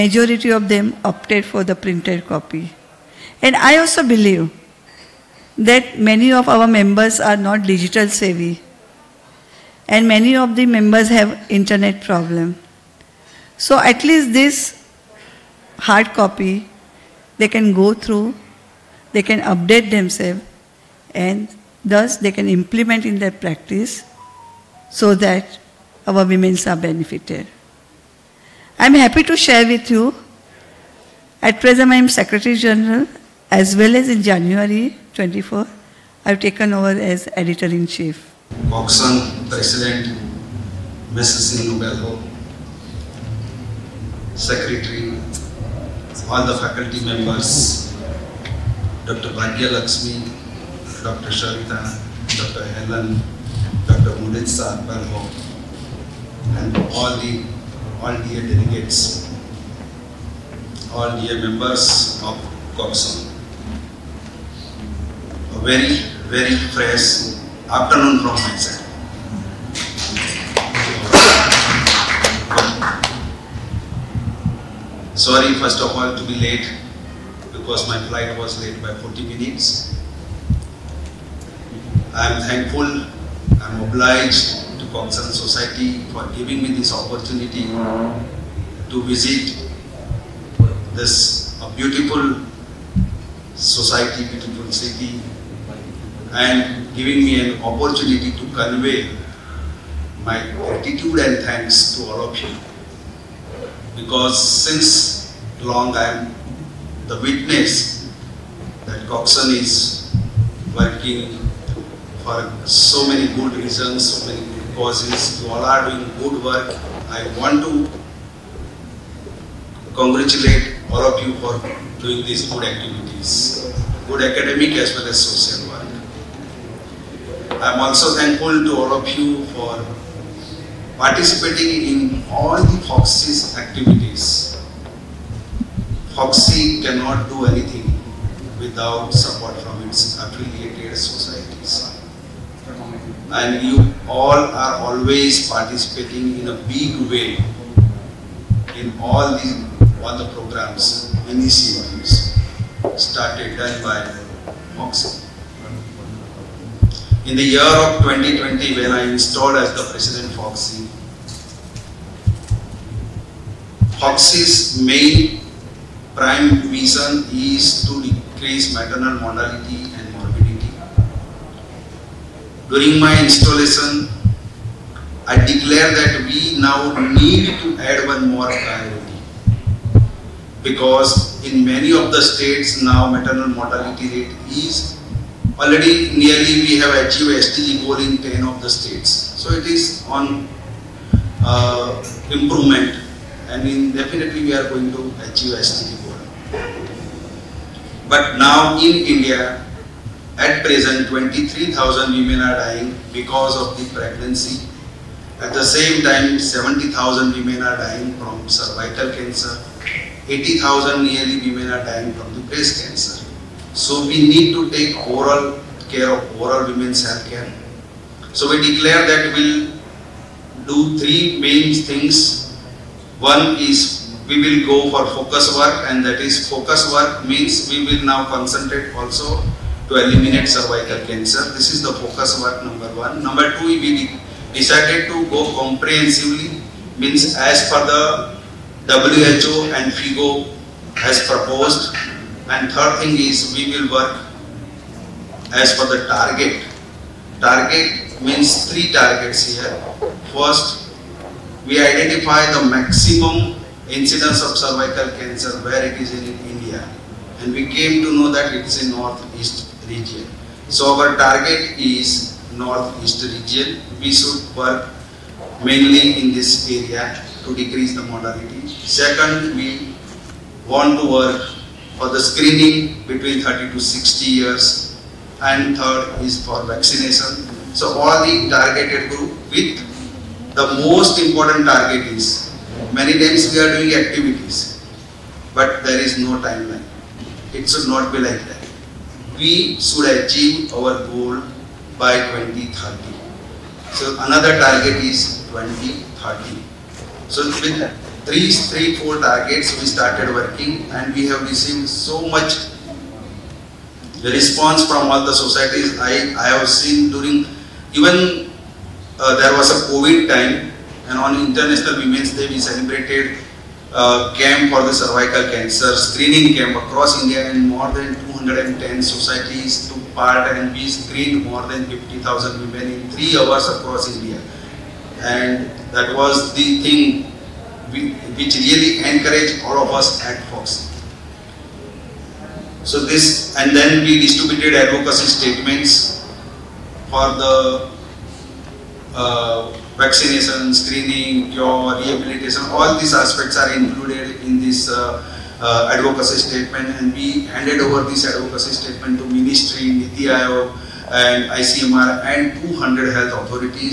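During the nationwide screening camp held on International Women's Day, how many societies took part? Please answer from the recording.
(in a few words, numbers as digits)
210.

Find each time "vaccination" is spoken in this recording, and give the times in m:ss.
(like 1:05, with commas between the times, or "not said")
4:36, 5:39.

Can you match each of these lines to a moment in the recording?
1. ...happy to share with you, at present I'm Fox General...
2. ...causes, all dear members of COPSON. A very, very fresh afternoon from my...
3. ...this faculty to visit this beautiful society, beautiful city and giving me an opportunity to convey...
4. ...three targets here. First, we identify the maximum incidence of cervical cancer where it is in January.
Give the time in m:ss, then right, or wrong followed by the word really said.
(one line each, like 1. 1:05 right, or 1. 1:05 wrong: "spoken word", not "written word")
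1. 0:28 wrong: "Secretary", not "Fox"
2. 0:58 wrong: "delegates", not "causes"
3. 1:26 wrong: "opportunity", not "faculty"
4. 4:08 wrong: "India", not "January".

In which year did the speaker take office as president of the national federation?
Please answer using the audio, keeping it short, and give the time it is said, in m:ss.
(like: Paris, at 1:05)
2020, at 2:38.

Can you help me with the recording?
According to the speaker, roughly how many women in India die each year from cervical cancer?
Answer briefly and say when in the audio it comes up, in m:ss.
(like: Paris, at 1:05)
70,000, at 3:26.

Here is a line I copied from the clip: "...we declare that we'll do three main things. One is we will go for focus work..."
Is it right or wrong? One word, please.
right.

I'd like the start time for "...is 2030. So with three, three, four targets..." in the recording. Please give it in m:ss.
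4:55.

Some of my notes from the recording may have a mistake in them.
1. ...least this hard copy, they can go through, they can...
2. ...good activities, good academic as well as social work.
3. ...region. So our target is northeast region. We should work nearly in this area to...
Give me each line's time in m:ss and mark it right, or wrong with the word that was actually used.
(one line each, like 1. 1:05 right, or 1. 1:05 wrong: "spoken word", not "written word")
1. 0:14 right
2. 2:02 right
3. 4:19 wrong: "mainly", not "nearly".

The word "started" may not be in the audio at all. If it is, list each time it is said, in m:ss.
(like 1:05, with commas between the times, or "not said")
2:33, 4:59.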